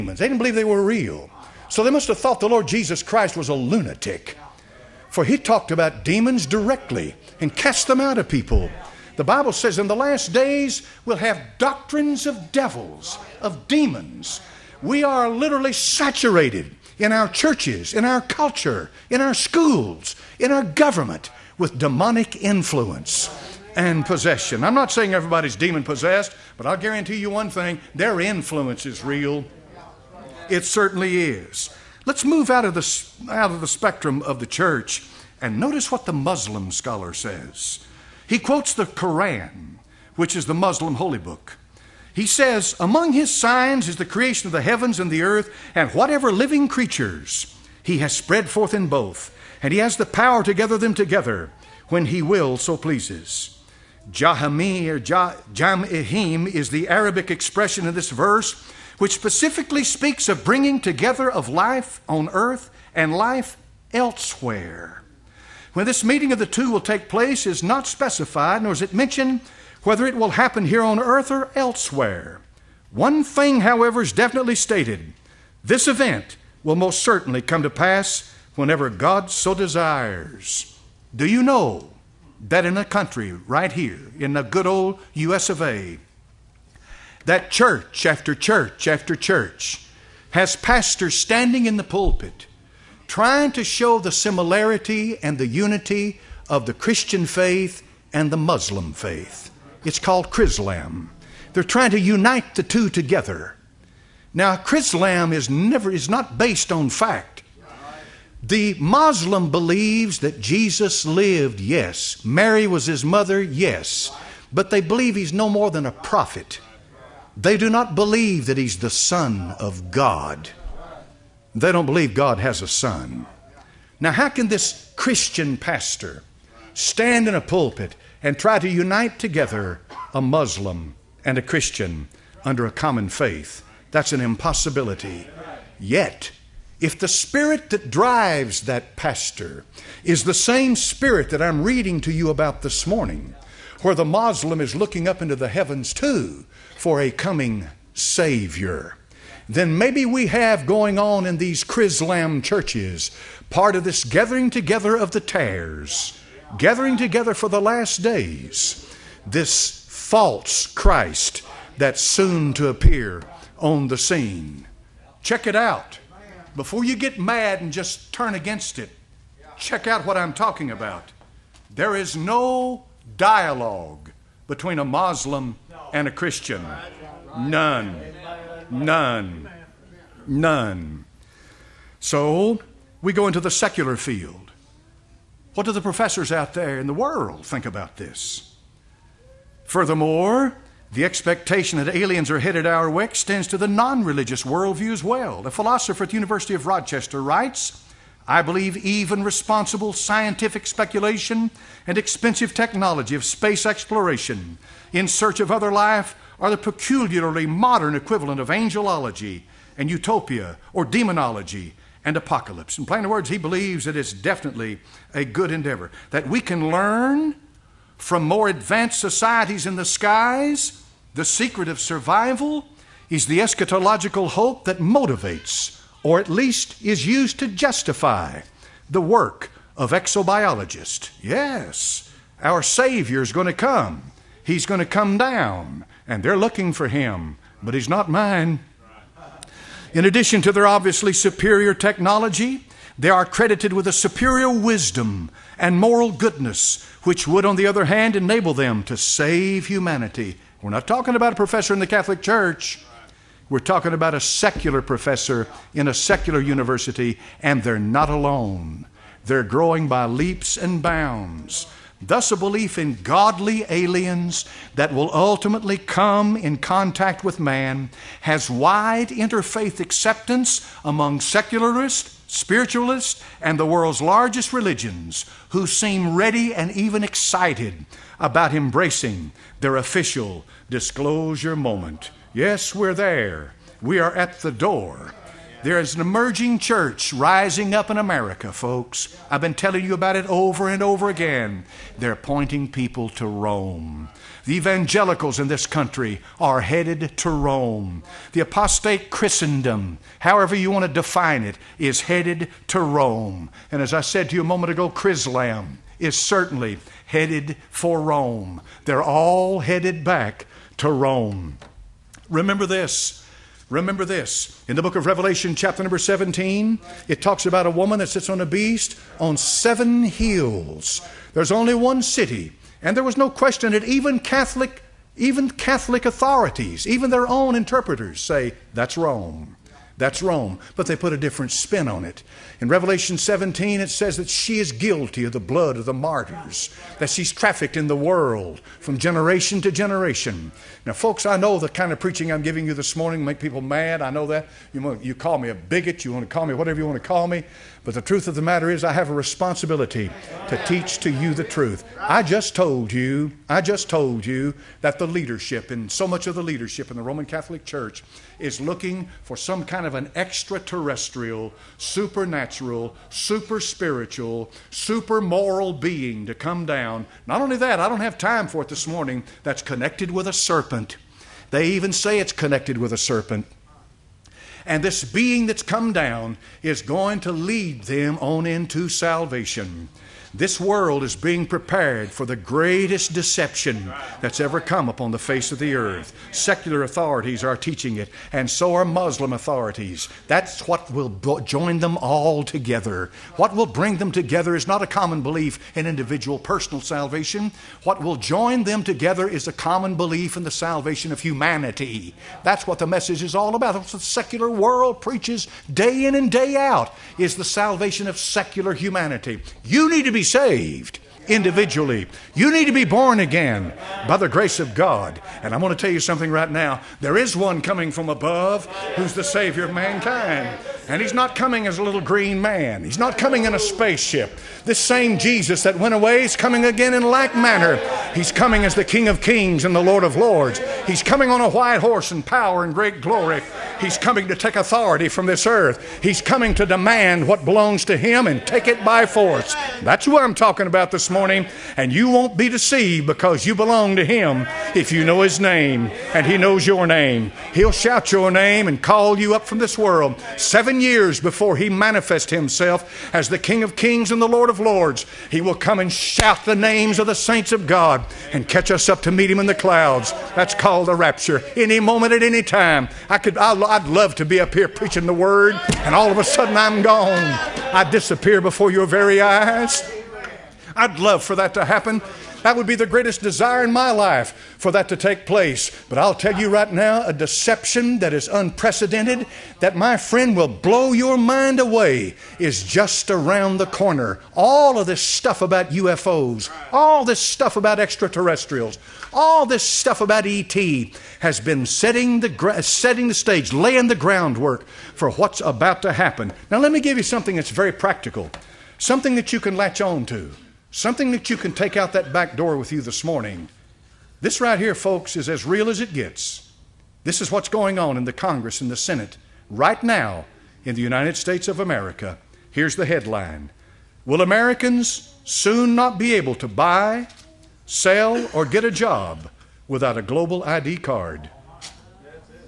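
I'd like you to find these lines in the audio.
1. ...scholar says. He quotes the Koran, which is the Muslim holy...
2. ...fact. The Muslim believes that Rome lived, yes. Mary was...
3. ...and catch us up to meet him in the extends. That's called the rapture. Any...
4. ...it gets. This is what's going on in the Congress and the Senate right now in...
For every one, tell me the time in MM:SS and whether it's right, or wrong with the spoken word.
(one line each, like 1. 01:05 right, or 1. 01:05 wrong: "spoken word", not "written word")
1. 00:36 right
2. 01:46 wrong: "Jesus", not "Rome"
3. 07:38 wrong: "clouds", not "extends"
4. 08:25 right.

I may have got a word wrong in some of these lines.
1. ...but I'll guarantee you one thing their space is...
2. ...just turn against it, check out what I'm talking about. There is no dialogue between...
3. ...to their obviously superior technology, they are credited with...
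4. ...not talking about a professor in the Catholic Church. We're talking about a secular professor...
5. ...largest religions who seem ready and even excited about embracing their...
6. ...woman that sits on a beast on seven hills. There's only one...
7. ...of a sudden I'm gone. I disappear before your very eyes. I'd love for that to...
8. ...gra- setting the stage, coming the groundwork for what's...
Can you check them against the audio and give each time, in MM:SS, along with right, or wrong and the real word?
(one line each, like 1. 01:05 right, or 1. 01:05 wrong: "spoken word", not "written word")
1. 00:26 wrong: "influence", not "space"
2. 02:47 right
3. 04:00 right
4. 04:10 right
5. 04:34 right
6. 05:17 right
7. 07:46 right
8. 08:12 wrong: "laying", not "coming".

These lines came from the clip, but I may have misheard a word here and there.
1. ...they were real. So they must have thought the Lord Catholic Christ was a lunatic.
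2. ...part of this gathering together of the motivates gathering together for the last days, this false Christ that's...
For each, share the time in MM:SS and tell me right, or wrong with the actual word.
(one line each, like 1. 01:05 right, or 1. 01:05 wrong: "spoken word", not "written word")
1. 00:00 wrong: "Jesus", not "Catholic"
2. 02:33 wrong: "tares", not "motivates".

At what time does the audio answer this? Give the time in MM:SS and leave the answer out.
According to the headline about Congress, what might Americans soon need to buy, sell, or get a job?
08:40.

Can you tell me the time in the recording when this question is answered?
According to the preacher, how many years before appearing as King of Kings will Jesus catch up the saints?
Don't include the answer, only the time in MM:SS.
07:30.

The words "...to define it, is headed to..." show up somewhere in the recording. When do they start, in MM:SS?
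05:00.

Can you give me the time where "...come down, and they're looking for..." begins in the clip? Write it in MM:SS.
03:54.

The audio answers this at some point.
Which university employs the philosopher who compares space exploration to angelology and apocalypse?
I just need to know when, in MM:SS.
03:16.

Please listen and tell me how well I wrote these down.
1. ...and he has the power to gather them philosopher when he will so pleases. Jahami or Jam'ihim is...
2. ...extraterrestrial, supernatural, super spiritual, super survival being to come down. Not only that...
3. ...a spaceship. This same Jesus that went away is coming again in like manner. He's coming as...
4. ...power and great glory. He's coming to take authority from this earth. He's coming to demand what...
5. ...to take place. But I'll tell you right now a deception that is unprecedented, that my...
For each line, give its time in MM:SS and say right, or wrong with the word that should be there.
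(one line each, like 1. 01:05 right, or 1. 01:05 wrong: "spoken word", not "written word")
1. 00:49 wrong: "together", not "philosopher"
2. 06:00 wrong: "moral", not "survival"
3. 07:03 right
4. 07:12 right
5. 07:54 right.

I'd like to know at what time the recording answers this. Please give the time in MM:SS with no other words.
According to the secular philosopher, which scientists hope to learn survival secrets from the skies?
03:49.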